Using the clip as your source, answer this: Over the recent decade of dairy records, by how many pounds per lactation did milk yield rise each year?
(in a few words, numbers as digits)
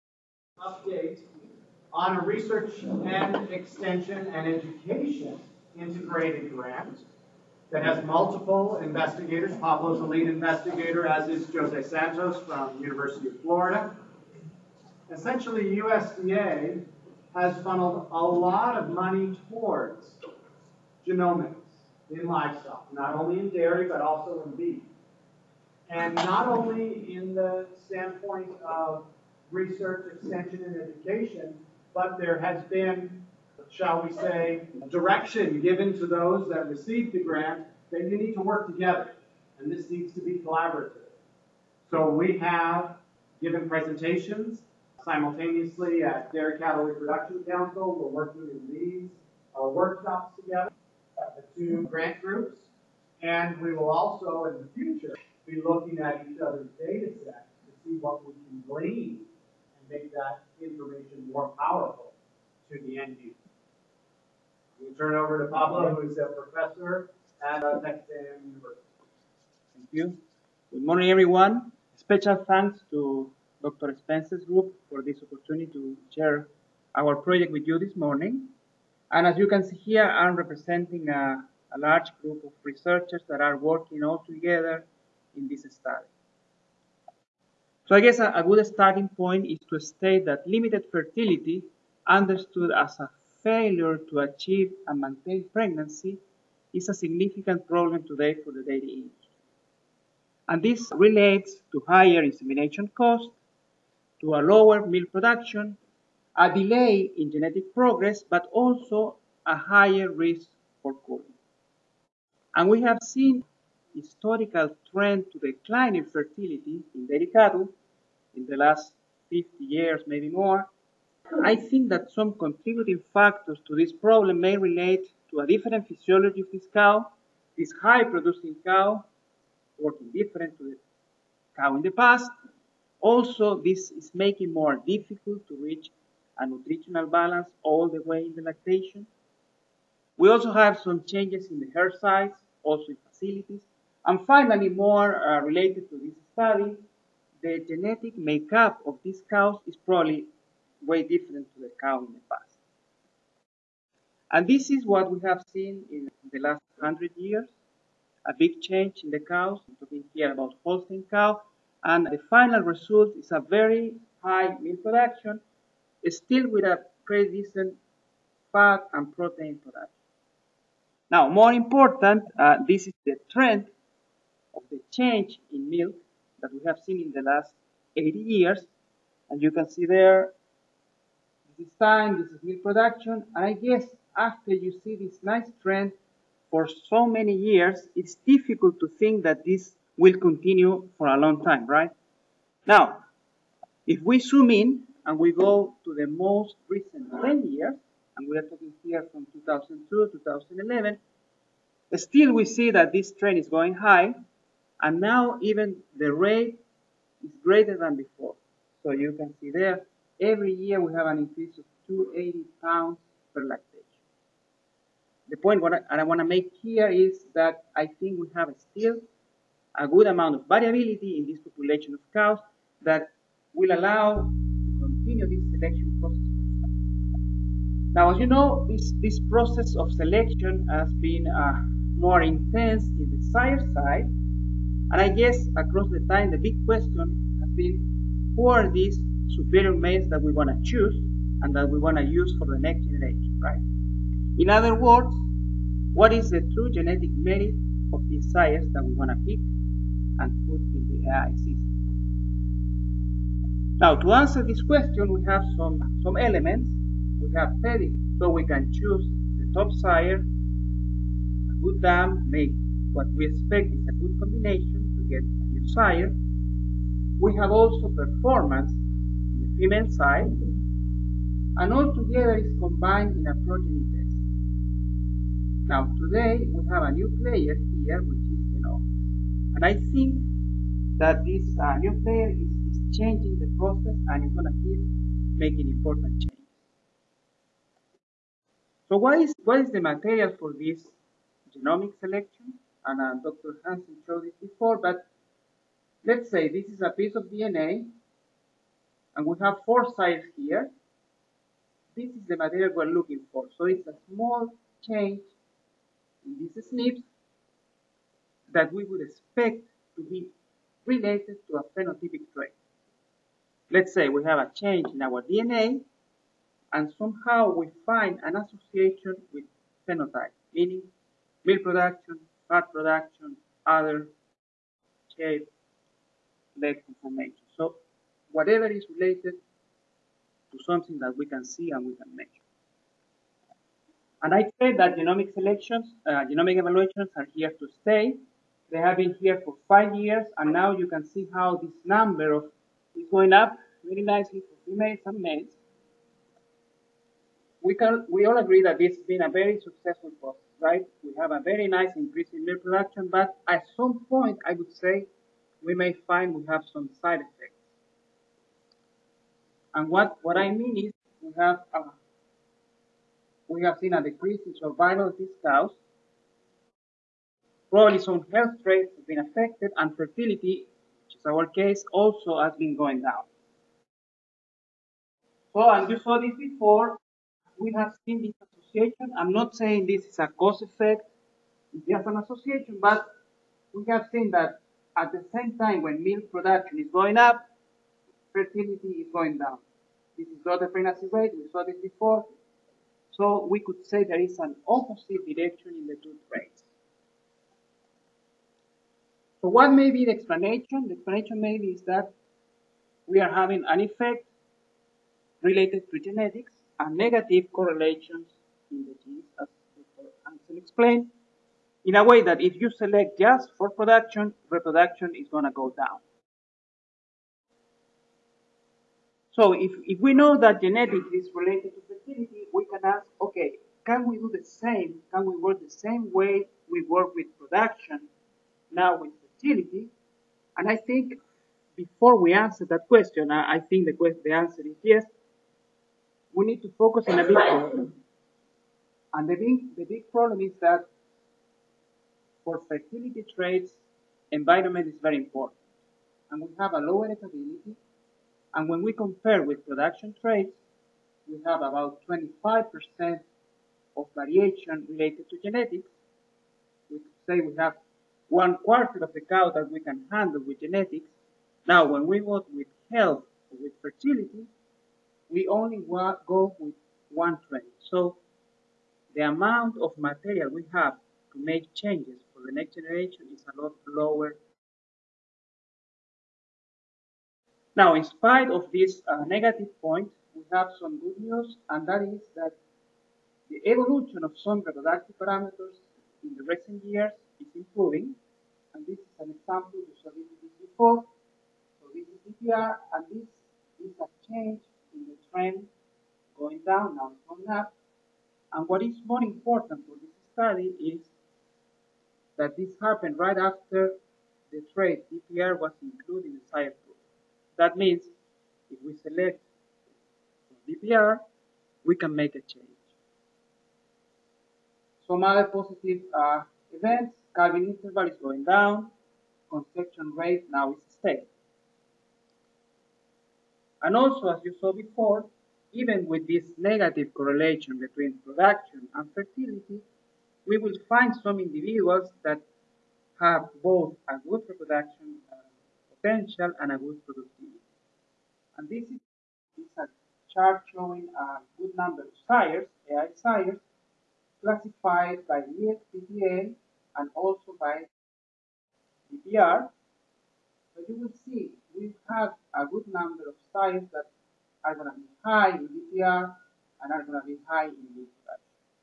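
280.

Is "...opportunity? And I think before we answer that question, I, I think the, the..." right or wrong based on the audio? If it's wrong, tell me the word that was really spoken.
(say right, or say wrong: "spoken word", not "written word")
wrong: "fertility", not "opportunity".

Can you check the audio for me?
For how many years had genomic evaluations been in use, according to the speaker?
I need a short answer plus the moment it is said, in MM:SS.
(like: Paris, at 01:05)
5, at 05:39.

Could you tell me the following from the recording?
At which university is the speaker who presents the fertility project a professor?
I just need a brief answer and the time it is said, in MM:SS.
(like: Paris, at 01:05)
Texas A&M University, at 01:07.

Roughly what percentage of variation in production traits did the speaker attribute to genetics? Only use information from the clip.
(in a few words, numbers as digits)
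25%.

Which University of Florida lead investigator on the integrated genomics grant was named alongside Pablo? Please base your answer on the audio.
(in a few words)
Jose Santos.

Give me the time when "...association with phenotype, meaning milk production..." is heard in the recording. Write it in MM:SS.
05:18.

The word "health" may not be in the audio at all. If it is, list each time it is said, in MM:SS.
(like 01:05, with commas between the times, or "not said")
06:08, 07:42.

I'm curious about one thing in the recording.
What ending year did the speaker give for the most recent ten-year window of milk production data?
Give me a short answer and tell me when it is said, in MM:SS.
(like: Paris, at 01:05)
2011, at 03:20.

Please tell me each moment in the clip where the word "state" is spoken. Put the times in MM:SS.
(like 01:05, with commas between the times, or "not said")
01:29.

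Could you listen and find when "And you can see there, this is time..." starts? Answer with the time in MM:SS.
02:59.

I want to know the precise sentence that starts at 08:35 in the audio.
Some other positive uh, events, calving interval is going down, conception rate now is stable.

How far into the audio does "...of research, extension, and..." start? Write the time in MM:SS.
00:28.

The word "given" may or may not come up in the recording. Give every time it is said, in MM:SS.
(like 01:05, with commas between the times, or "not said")
00:35, 00:43.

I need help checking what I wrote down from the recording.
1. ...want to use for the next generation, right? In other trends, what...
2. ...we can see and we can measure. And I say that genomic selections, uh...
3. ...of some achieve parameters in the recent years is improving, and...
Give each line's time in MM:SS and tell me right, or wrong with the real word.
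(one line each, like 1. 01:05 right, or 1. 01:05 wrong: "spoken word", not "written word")
1. 04:01 wrong: "words", not "trends"
2. 05:31 right
3. 08:04 wrong: "reproductive", not "achieve".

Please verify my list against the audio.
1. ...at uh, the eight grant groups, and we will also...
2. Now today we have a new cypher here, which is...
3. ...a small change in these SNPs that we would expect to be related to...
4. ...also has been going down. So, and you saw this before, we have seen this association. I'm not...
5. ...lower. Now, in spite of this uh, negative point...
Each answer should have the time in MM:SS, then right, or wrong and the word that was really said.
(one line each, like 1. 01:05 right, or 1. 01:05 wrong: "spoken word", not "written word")
1. 00:51 wrong: "two", not "eight"
2. 04:35 wrong: "player", not "cypher"
3. 05:03 right
4. 06:11 right
5. 07:53 right.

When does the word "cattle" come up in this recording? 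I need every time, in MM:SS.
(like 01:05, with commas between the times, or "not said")
00:46, 01:57.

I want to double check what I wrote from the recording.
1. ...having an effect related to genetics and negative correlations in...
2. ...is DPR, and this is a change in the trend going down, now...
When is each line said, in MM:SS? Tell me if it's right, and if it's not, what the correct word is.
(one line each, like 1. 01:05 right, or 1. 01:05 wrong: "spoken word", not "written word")
1. 06:43 right
2. 08:12 right.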